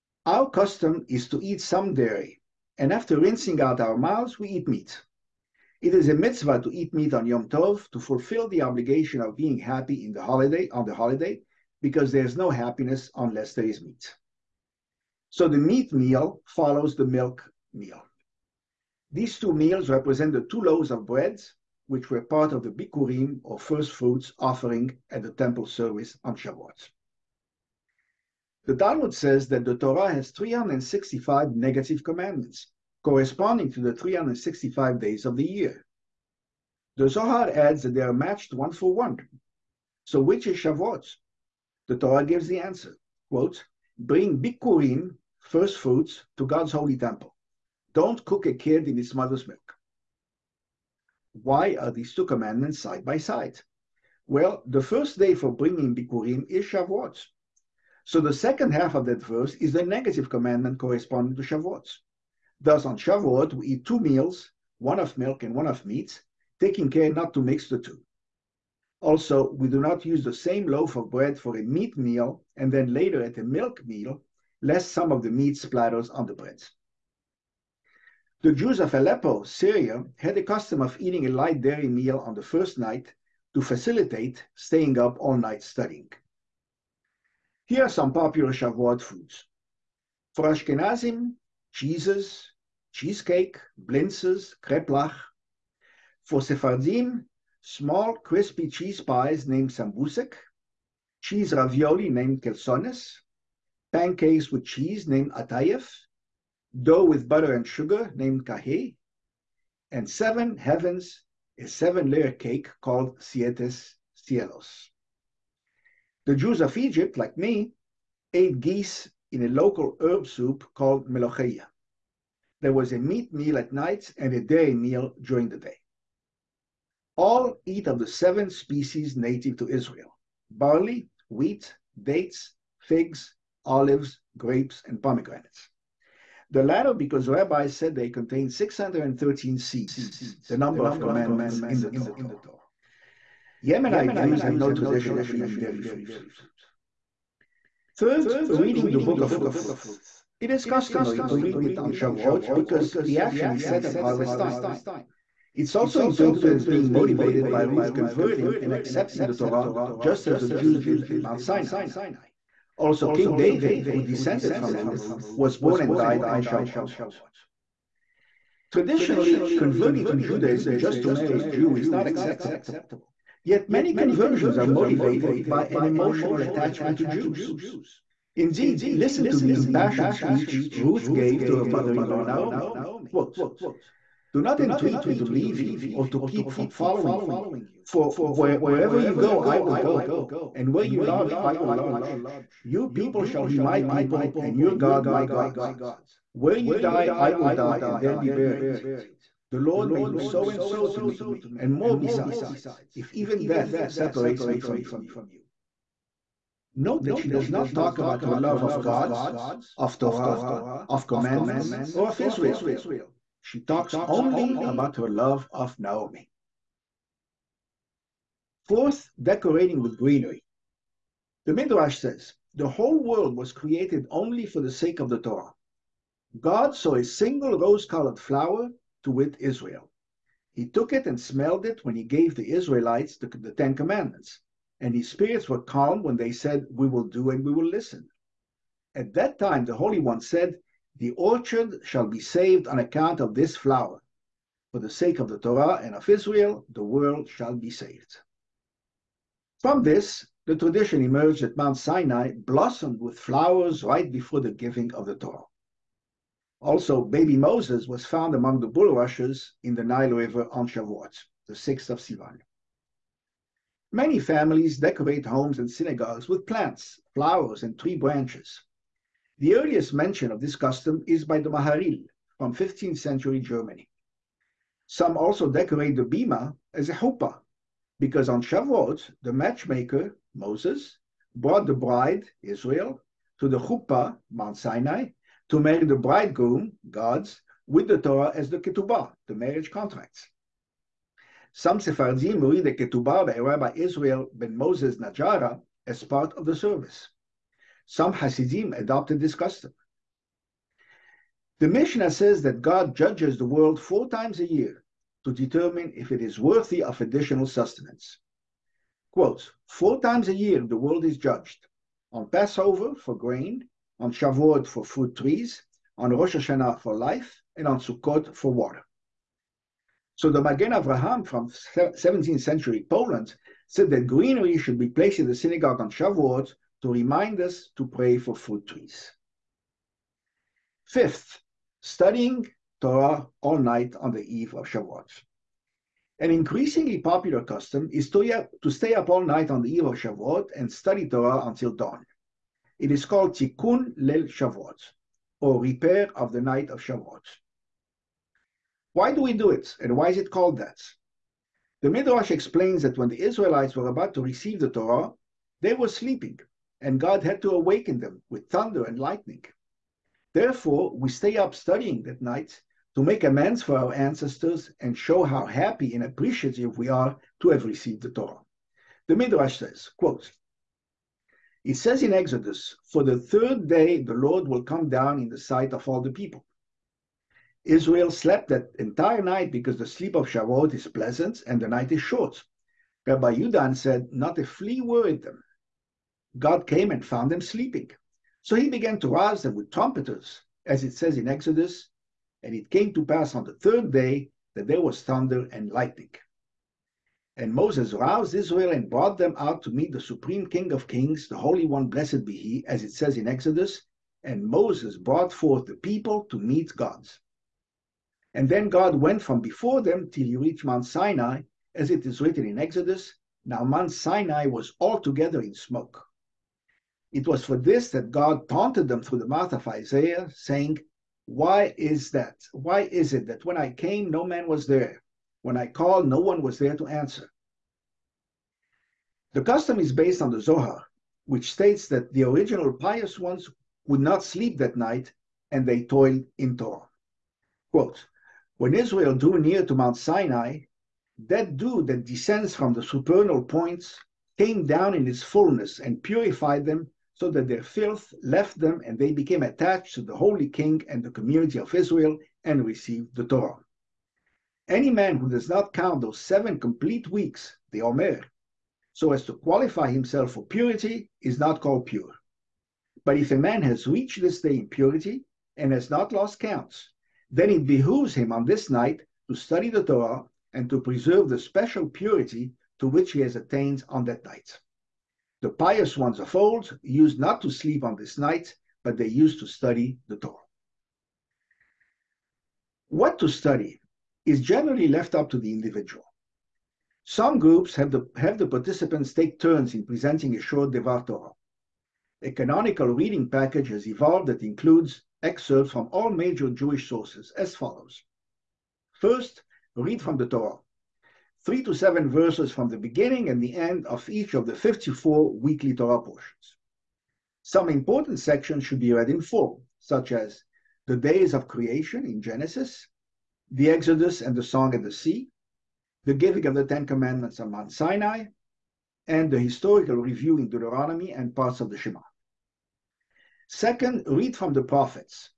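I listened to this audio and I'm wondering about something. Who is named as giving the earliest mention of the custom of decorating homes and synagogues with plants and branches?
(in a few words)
the Maharil.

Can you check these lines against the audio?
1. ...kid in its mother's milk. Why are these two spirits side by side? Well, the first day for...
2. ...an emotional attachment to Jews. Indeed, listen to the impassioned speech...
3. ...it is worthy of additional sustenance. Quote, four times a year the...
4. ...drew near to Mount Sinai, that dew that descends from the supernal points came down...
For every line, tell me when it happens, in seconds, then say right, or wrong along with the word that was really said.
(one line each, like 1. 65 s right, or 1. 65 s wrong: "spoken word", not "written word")
1. 48 s wrong: "commandments", not "spirits"
2. 175 s right
3. 306 s right
4. 439 s right.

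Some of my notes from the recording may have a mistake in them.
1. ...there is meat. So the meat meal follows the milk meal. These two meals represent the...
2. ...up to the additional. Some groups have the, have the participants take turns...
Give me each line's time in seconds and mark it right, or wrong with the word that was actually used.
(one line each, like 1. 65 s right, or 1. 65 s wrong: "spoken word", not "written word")
1. 13 s right
2. 485 s wrong: "individual", not "additional".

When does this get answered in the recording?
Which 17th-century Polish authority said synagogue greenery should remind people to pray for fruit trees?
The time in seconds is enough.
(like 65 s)
320 s.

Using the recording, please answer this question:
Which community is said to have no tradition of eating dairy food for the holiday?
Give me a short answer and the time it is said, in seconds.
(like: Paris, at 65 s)
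Yemenite Jews, at 143 s.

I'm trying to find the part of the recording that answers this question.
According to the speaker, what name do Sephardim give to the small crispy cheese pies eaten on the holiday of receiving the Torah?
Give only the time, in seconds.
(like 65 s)
99 s.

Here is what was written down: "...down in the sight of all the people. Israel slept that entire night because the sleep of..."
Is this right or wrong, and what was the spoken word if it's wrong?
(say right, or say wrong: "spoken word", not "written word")
right.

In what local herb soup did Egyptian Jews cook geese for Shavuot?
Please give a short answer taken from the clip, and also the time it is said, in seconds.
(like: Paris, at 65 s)
melocheia, at 121 s.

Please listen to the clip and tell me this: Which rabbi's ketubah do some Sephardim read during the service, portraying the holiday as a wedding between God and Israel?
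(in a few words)
Rabbi Israel ben Moses Najara.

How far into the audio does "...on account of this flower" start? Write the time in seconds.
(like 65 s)
242 s.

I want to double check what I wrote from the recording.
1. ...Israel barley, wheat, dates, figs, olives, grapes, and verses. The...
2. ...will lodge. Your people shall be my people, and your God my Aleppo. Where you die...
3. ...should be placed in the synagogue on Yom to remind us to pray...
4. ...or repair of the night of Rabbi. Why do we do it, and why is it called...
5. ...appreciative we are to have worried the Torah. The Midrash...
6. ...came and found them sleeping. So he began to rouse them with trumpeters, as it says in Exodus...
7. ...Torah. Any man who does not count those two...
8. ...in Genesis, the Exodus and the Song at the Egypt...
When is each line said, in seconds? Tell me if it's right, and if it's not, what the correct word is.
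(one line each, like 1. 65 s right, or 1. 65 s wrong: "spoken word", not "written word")
1. 129 s wrong: "pomegranates", not "verses"
2. 191 s wrong: "God", not "Aleppo"
3. 324 s wrong: "Shavuot", not "Yom"
4. 345 s wrong: "Shavuot", not "Rabbi"
5. 366 s wrong: "received", not "worried"
6. 386 s right
7. 453 s wrong: "seven", not "two"
8. 512 s wrong: "Sea", not "Egypt".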